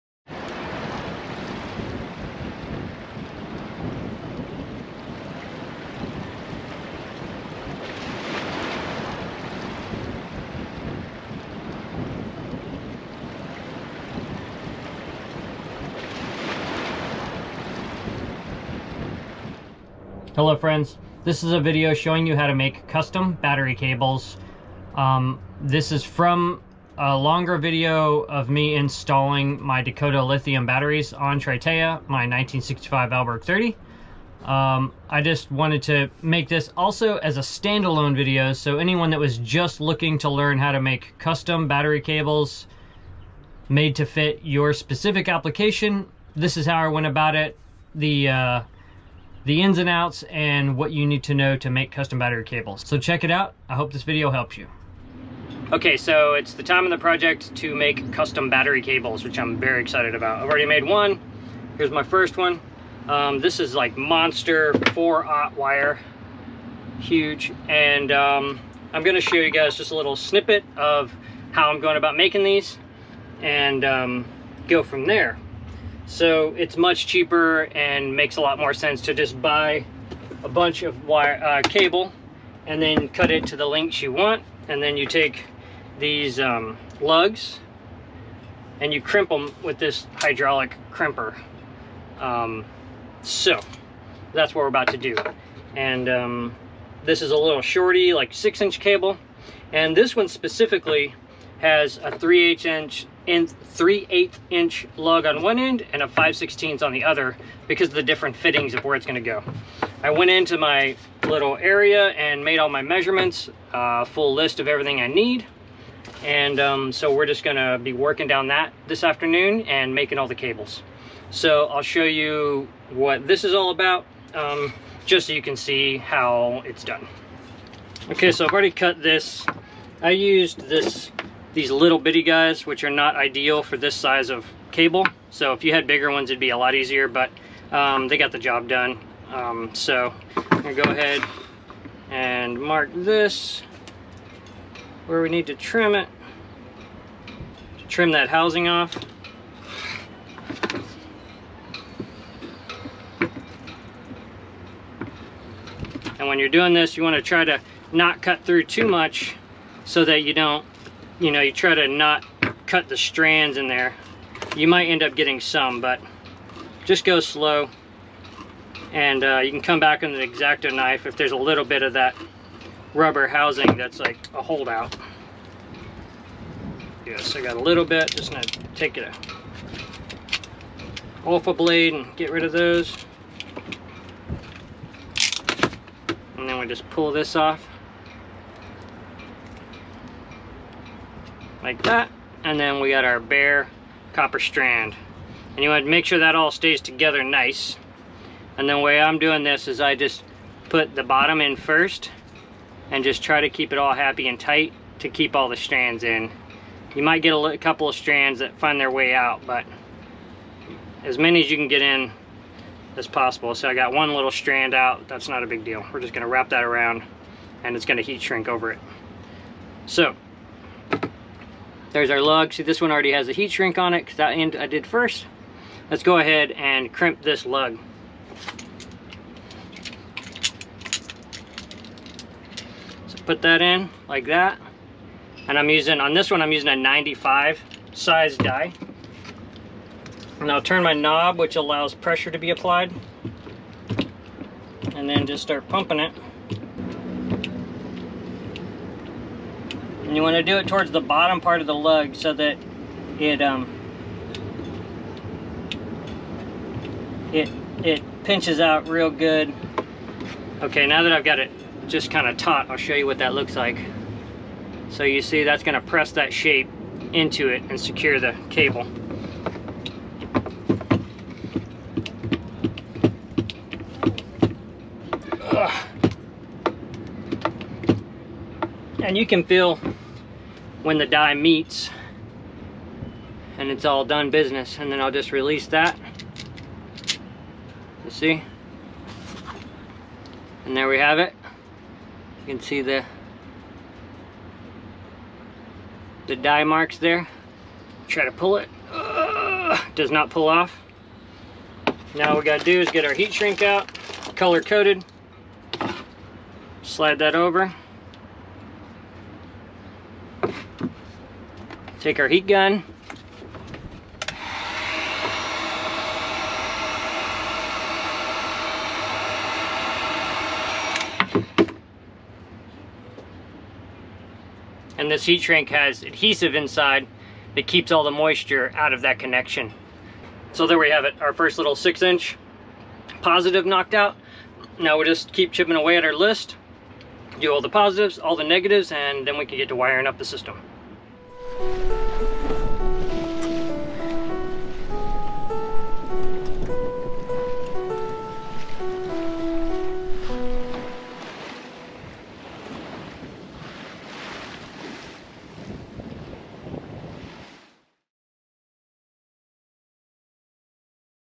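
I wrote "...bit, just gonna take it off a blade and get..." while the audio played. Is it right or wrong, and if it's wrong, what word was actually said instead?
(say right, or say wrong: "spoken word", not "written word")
right.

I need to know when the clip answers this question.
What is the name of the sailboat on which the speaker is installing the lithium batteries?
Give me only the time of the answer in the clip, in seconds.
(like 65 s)
31 s.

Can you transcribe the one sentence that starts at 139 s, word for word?
Um, so I'm gonna go ahead and mark this where we need to trim it, to trim that housing off.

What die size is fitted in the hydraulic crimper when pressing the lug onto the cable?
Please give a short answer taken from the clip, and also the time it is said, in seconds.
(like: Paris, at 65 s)
95, at 236 s.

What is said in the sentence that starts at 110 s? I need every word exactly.
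I went into my little area and made all my measurements, uh, full list of everything I need.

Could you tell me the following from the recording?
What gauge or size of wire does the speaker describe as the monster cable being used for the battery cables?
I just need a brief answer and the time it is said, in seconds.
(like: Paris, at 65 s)
4-aught, at 64 s.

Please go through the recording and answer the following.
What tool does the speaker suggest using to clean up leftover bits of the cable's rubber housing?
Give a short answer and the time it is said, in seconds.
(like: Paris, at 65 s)
X-Acto knife, at 170 s.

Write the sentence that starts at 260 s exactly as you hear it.
Okay, now that I've got it just kind of taut, I'll show you what that looks like.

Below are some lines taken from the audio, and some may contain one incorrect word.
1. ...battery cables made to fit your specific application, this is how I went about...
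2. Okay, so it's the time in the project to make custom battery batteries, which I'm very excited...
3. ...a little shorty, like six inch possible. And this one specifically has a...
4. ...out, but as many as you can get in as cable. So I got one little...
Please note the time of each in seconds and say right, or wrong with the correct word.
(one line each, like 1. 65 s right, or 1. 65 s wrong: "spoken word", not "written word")
1. 41 s right
2. 55 s wrong: "cables", not "batteries"
3. 97 s wrong: "cable", not "possible"
4. 209 s wrong: "possible", not "cable".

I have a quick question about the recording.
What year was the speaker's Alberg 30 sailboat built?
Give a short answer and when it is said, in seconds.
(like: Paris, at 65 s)
1965, at 32 s.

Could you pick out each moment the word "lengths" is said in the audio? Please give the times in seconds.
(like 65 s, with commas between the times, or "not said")
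83 s.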